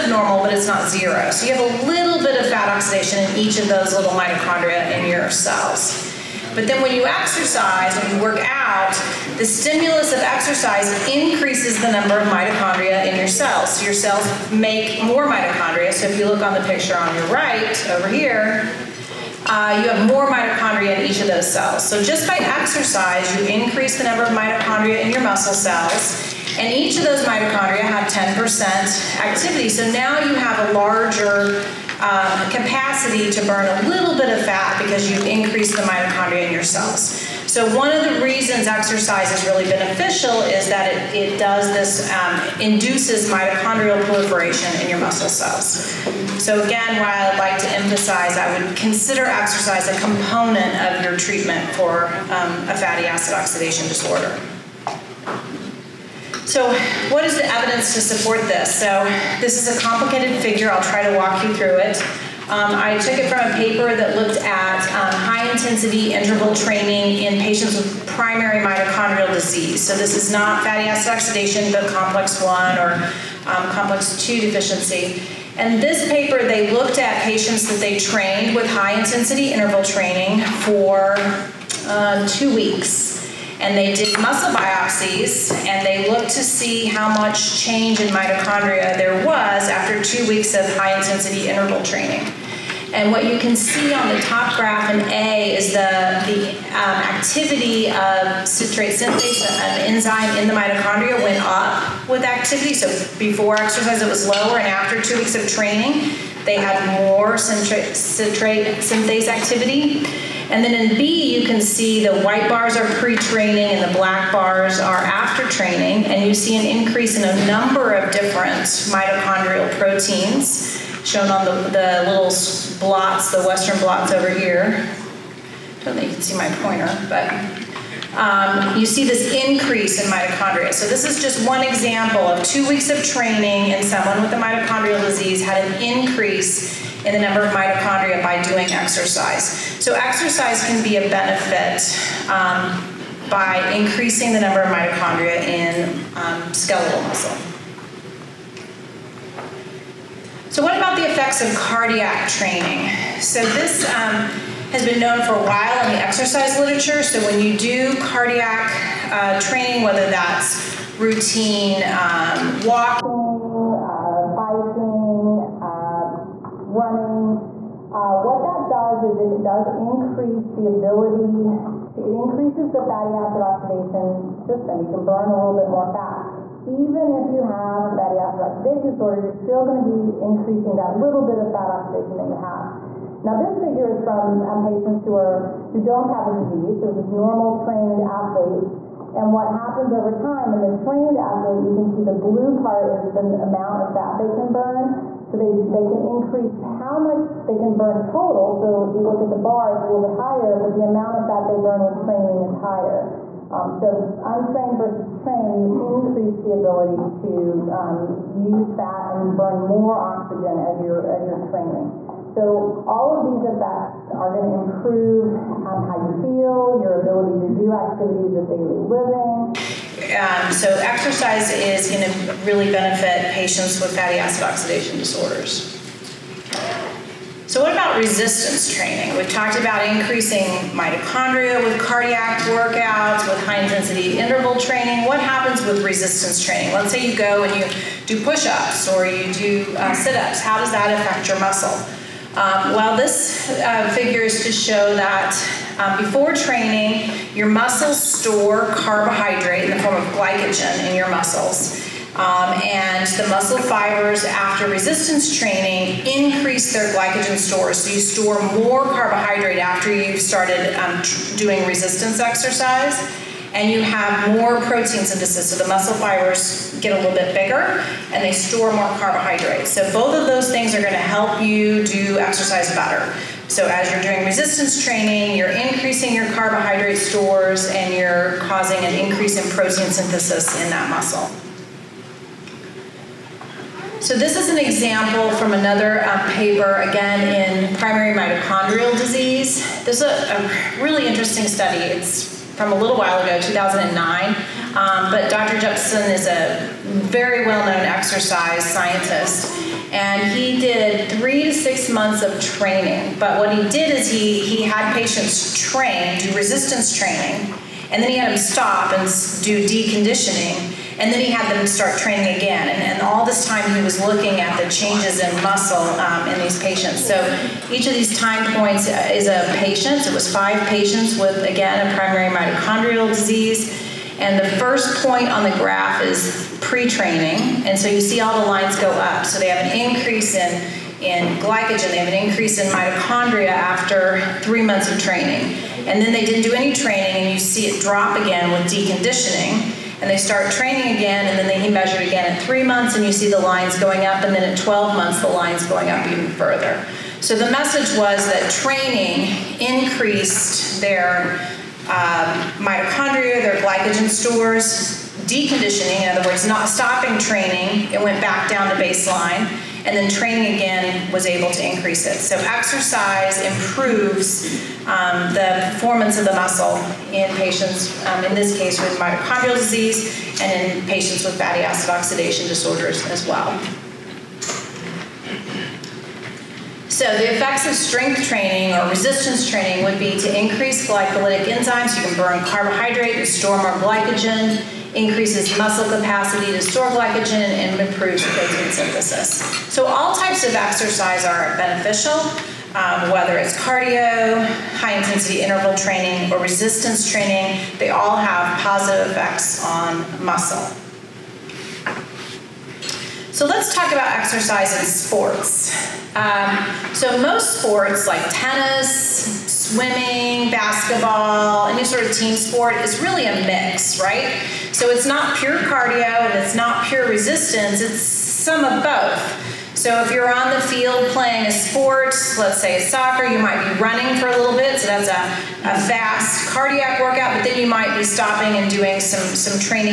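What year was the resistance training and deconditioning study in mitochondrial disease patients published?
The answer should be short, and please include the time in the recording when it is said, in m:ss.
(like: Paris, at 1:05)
2009, at 4:53.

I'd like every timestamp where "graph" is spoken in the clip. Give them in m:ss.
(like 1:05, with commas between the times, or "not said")
1:34, 5:25.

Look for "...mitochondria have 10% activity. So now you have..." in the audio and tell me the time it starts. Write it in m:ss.
0:27.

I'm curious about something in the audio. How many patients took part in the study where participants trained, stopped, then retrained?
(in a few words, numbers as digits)
5.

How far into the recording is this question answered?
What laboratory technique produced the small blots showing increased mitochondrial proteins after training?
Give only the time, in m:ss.
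2:03.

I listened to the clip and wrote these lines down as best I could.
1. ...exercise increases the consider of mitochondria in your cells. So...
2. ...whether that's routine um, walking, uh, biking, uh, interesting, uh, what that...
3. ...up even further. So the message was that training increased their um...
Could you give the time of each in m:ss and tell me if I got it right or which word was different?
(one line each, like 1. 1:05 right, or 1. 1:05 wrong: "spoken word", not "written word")
1. 0:10 wrong: "number", not "consider"
2. 2:39 wrong: "running", not "interesting"
3. 5:45 right.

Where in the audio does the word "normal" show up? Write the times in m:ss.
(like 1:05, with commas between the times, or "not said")
0:00, 3:07.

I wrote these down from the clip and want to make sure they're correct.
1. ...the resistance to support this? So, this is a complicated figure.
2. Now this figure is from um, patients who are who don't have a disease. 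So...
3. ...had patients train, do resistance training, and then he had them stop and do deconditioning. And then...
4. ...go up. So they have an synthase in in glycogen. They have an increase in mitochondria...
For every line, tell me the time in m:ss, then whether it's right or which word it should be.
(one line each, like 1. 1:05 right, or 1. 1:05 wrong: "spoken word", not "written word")
1. 0:57 wrong: "evidence", not "resistance"
2. 3:03 right
3. 5:04 right
4. 5:28 wrong: "increase", not "synthase".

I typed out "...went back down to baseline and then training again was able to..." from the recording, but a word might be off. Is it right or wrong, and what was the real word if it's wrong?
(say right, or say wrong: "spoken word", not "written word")
right.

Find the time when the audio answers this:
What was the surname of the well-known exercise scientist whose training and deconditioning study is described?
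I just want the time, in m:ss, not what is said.
4:55.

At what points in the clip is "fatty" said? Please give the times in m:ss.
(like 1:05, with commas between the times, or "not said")
0:52, 1:10, 2:52, 2:57, 3:43, 6:11.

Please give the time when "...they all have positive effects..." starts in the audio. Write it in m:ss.
6:37.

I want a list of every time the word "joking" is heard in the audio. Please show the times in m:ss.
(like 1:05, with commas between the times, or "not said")
not said.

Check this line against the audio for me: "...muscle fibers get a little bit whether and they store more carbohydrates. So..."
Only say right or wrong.
wrong.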